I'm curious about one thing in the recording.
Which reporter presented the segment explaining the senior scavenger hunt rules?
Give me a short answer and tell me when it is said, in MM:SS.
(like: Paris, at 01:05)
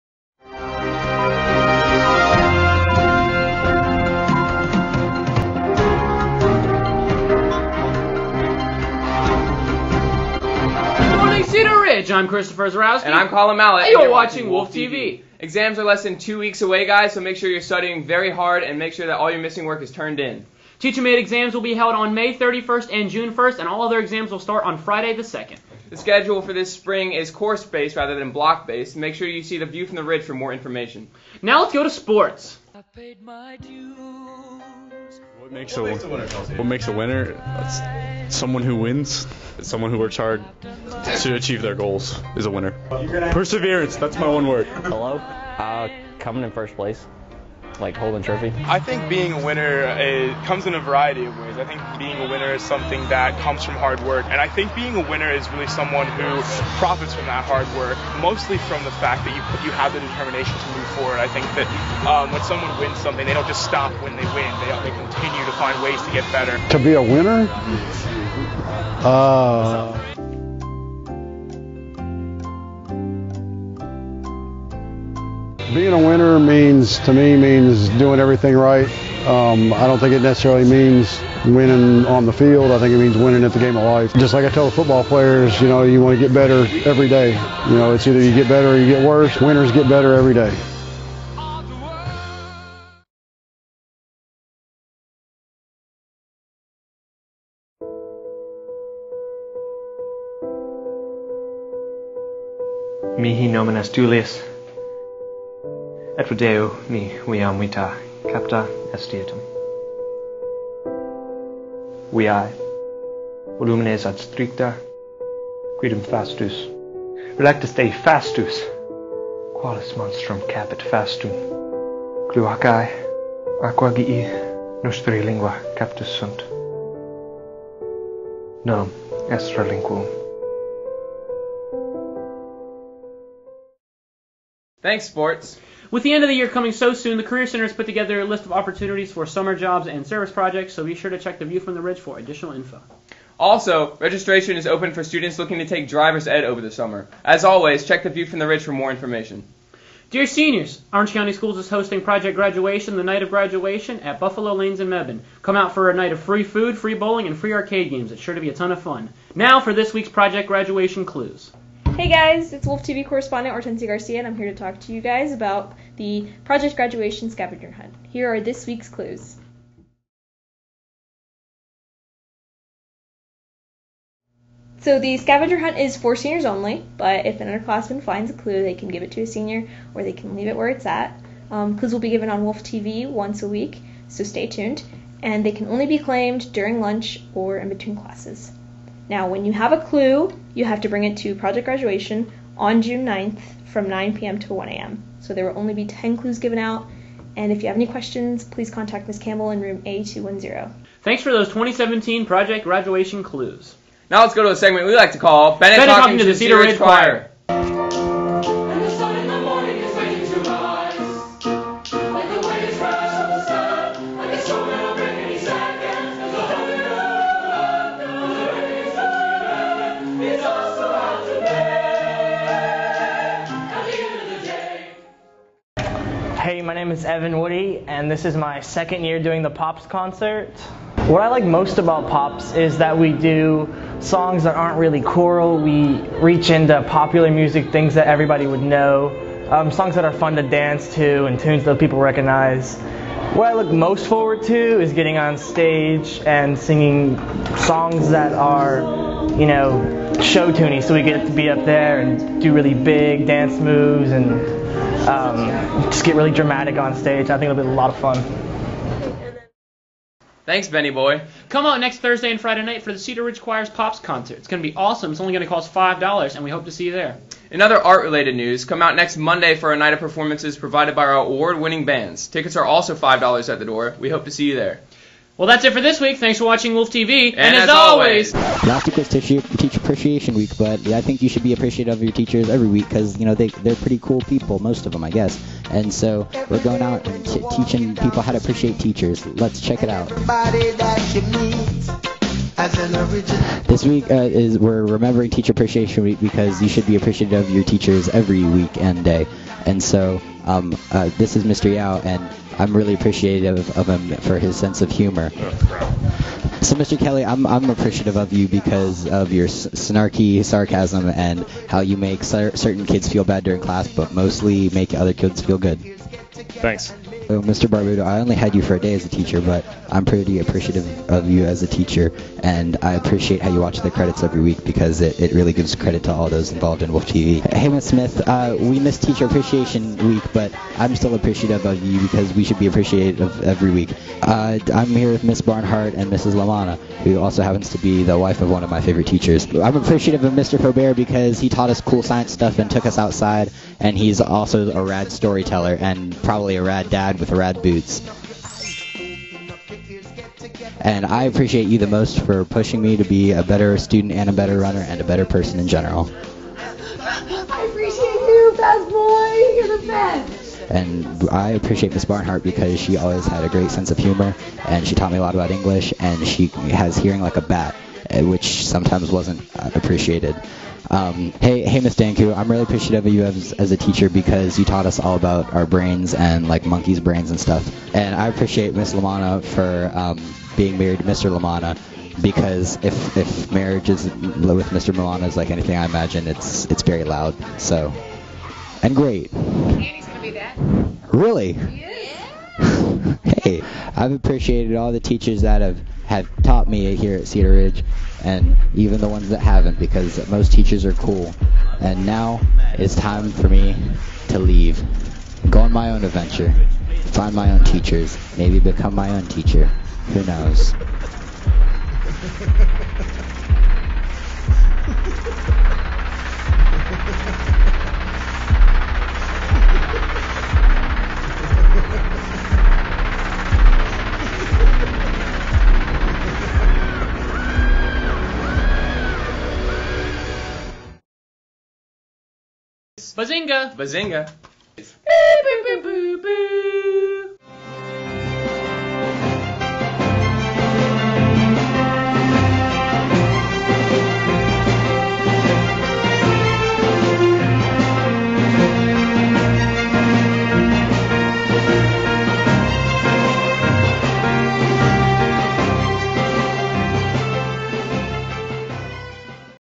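Hortensia Garcia, at 02:43.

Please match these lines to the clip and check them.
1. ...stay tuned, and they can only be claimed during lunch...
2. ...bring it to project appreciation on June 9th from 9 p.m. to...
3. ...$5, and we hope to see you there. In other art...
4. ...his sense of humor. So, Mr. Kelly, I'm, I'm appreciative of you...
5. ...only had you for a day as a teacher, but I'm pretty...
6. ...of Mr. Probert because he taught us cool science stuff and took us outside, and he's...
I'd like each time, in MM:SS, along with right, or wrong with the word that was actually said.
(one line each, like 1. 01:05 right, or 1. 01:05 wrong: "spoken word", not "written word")
1. 03:04 right
2. 03:10 wrong: "graduation", not "appreciation"
3. 04:25 right
4. 05:04 right
5. 05:18 right
6. 05:40 right.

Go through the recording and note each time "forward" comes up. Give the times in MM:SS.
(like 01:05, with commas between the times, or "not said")
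01:00, 04:04.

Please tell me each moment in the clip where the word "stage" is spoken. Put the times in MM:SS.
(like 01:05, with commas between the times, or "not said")
04:05, 04:16.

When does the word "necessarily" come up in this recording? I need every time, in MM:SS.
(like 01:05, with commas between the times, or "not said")
01:20.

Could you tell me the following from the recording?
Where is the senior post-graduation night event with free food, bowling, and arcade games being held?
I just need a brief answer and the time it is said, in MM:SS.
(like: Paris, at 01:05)
Buffalo Lanes in Mebane, at 02:34.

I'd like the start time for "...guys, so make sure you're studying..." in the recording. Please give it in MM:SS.
00:16.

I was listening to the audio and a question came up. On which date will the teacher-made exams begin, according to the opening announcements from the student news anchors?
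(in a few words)
May 31st.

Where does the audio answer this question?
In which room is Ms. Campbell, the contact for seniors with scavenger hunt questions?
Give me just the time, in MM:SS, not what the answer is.
03:19.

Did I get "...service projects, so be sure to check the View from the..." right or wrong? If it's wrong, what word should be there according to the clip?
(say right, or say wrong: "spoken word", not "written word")
right.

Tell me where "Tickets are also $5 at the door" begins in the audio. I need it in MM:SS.
04:32.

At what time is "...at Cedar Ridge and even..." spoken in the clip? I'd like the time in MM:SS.
06:37.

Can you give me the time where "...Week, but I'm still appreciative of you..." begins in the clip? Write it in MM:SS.
05:30.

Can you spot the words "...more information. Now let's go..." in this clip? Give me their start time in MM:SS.
00:30.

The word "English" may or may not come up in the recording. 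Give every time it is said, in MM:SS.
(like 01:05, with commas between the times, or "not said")
06:05.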